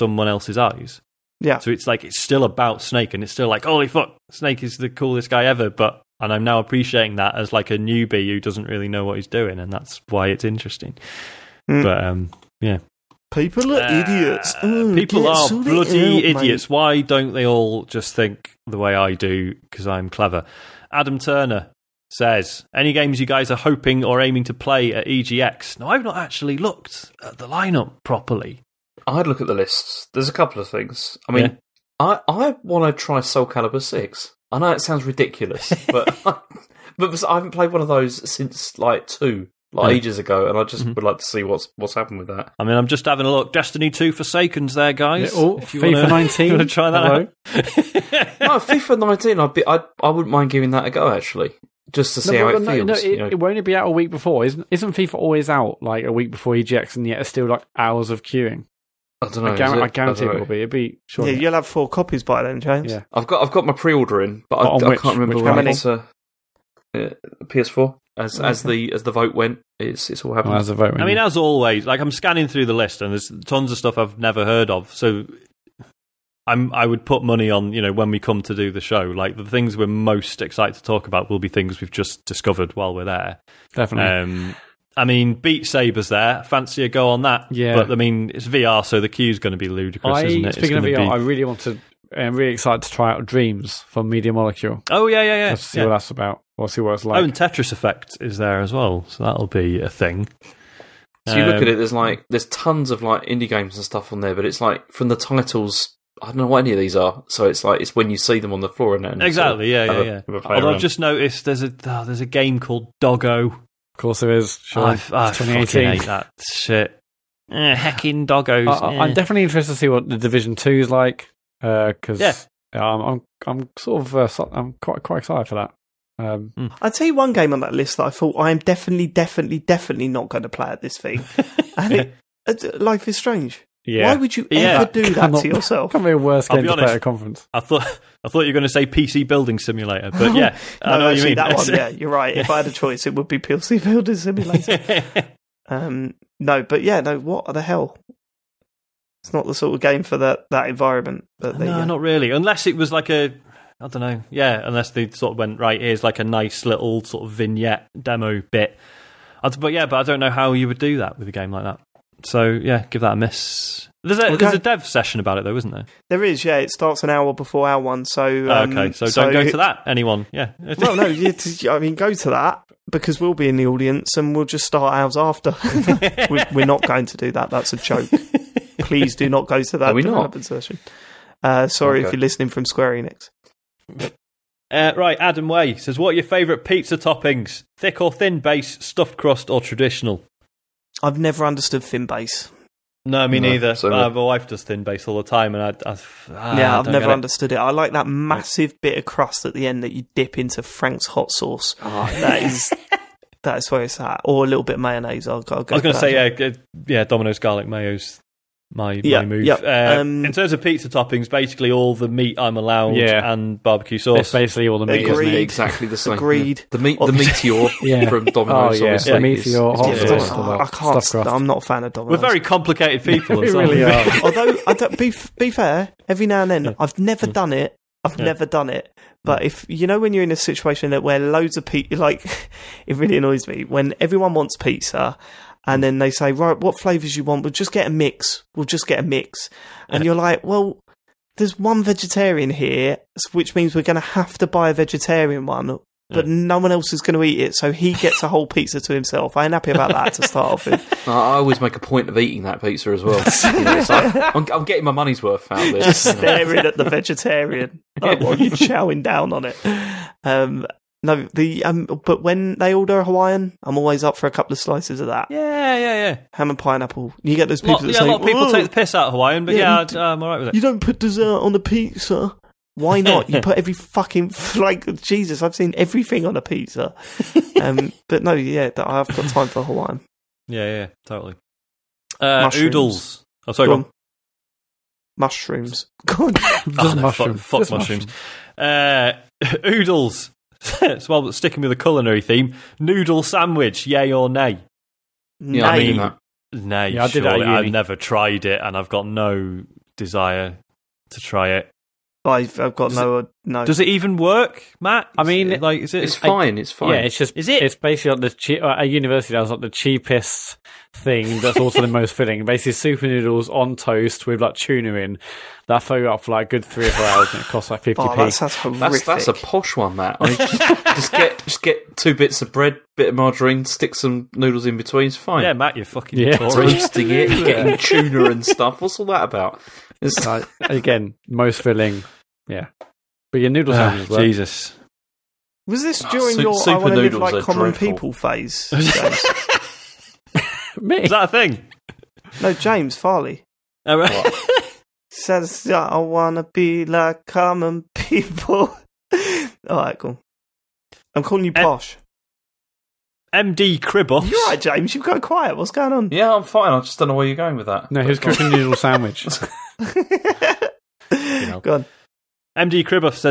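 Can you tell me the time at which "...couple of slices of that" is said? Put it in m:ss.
4:24.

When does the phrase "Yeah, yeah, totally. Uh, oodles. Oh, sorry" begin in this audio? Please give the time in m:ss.
4:40.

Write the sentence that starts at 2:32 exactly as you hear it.
Unless it was like a I don't know.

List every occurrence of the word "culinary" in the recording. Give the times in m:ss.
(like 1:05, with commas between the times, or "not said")
4:51.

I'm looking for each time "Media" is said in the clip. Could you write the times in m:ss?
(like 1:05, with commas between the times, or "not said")
1:34.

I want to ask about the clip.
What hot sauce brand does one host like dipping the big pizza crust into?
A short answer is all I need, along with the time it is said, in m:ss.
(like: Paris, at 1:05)
Frank's, at 3:20.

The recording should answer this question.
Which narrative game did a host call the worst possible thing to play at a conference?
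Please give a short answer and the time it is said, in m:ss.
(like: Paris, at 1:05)
Life is Strange, at 2:12.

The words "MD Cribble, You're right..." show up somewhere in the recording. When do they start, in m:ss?
5:53.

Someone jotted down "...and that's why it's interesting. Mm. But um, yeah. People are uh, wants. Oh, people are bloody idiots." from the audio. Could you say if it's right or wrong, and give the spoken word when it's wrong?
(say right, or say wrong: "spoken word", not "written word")
wrong: "idiots", not "wants".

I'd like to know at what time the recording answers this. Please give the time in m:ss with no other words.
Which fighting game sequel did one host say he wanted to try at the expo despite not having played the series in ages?
0:33.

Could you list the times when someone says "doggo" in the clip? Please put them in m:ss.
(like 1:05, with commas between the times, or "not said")
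1:52, 1:58.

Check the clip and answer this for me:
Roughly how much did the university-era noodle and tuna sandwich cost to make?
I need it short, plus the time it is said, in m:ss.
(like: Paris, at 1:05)
50p, at 5:17.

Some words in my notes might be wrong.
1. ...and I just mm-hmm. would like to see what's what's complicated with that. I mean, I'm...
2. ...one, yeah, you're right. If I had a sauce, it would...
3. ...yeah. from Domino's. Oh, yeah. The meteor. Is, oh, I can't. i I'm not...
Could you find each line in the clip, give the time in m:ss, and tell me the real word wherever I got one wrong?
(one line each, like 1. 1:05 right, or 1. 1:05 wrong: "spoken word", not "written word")
1. 0:40 wrong: "happened", not "complicated"
2. 2:21 wrong: "choice", not "sauce"
3. 3:37 right.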